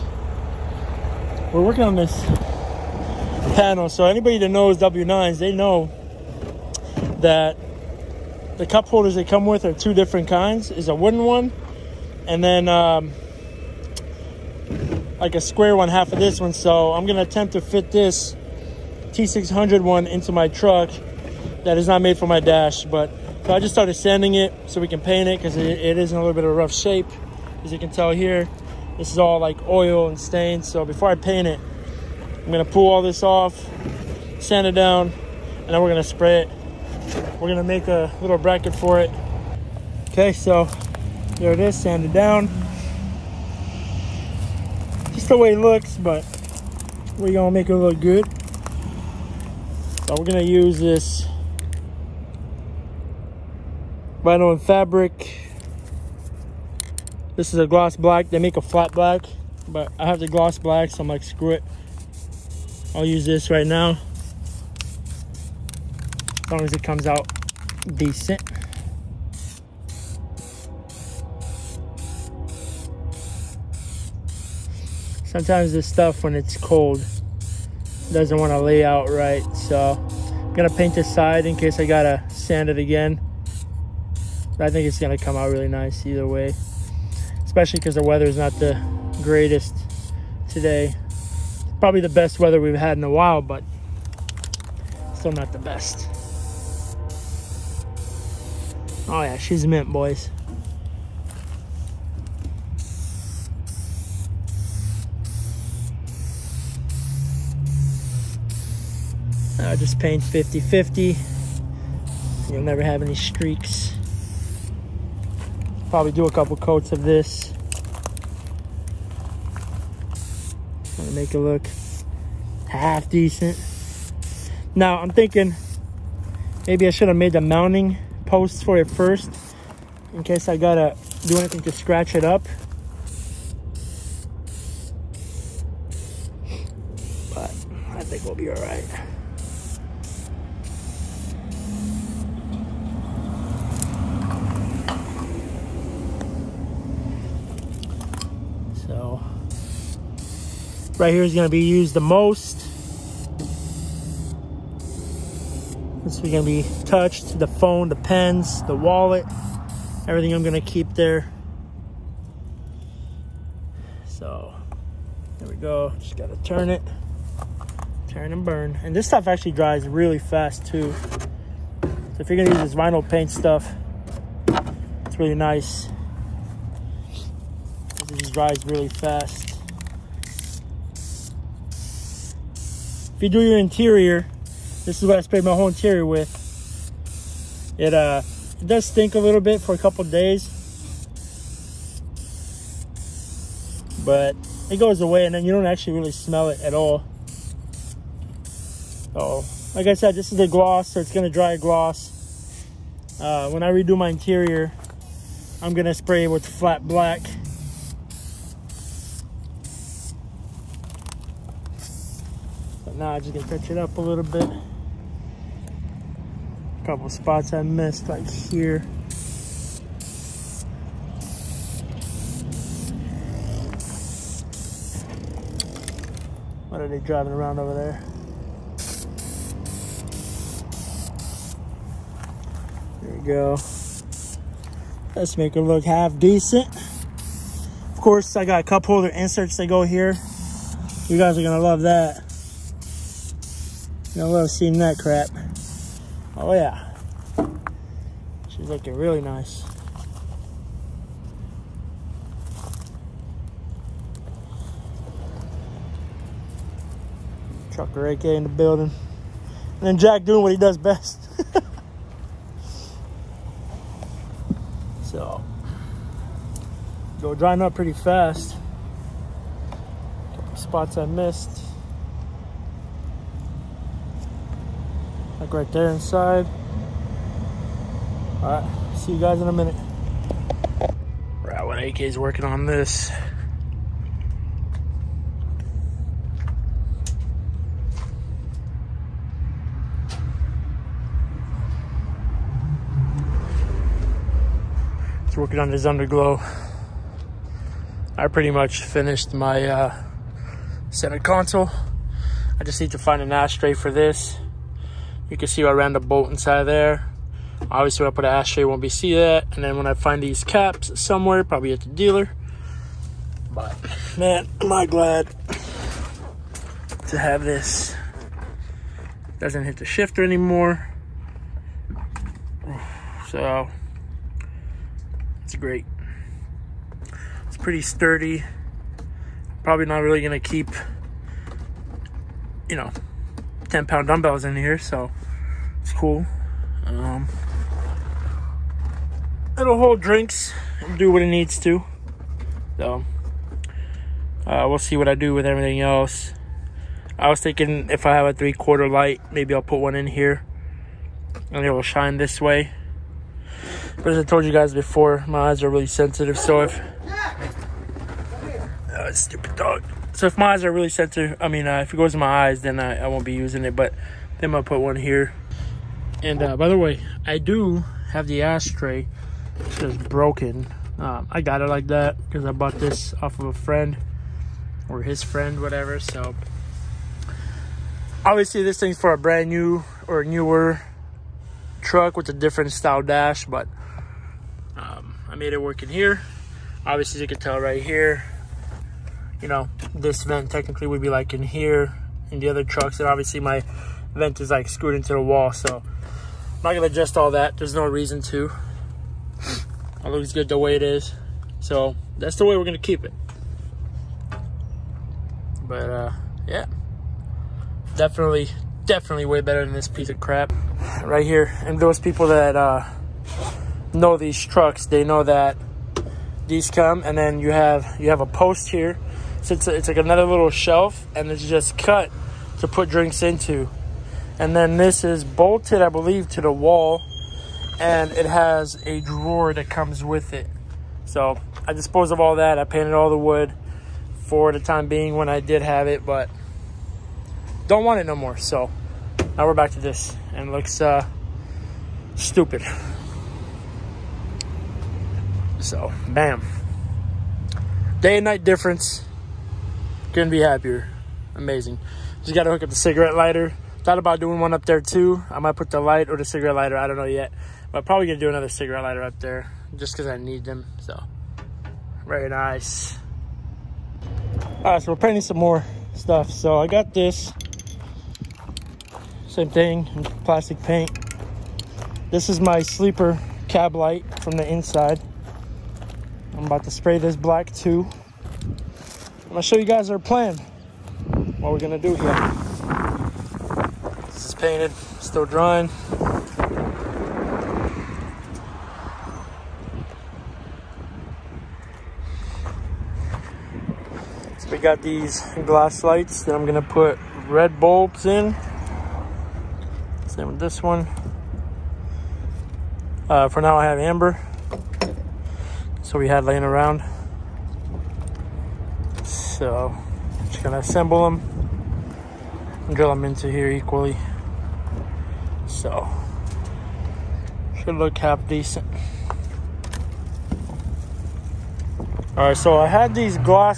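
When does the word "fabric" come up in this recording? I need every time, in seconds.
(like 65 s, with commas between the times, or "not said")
54 s.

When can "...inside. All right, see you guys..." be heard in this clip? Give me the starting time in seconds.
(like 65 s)
275 s.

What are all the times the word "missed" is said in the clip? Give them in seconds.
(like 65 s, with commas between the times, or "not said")
217 s, 271 s.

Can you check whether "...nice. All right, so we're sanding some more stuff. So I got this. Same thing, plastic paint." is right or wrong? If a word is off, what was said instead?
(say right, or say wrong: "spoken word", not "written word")
wrong: "painting", not "sanding".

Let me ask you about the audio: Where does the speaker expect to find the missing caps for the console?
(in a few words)
At the dealer.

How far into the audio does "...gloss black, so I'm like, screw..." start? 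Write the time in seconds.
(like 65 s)
60 s.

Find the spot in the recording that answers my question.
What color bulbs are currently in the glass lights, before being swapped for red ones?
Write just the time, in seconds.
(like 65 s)
503 s.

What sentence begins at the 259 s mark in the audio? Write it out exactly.
And then Jack doing what he does best.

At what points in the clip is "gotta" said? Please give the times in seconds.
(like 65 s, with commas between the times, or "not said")
81 s, 130 s.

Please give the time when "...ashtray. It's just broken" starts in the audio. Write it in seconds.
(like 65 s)
368 s.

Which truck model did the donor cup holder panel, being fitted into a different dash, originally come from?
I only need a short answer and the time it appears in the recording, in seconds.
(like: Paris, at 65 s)
T600, at 19 s.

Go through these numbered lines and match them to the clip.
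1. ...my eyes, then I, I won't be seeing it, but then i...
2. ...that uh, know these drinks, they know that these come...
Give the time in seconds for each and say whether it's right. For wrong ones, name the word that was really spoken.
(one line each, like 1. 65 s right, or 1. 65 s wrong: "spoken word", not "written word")
1. 362 s wrong: "using", not "seeing"
2. 412 s wrong: "trucks", not "drinks".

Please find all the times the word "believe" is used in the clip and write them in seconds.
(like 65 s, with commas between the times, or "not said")
425 s.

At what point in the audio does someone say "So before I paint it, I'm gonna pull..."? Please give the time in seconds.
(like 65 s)
30 s.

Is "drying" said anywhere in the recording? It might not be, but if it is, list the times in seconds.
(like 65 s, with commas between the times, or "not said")
267 s, 485 s.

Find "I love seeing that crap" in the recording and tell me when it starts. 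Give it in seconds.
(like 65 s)
244 s.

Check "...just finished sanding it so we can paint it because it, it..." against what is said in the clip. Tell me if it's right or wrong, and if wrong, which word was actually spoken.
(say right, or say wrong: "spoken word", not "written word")
wrong: "started", not "finished".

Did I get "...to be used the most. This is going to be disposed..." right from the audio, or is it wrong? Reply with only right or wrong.
wrong.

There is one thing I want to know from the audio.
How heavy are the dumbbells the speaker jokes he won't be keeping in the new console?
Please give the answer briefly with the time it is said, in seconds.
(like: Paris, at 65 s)
10 pound, at 333 s.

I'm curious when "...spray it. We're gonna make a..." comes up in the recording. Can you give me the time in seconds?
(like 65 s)
36 s.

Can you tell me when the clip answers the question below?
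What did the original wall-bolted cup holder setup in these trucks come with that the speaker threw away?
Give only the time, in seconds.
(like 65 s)
429 s.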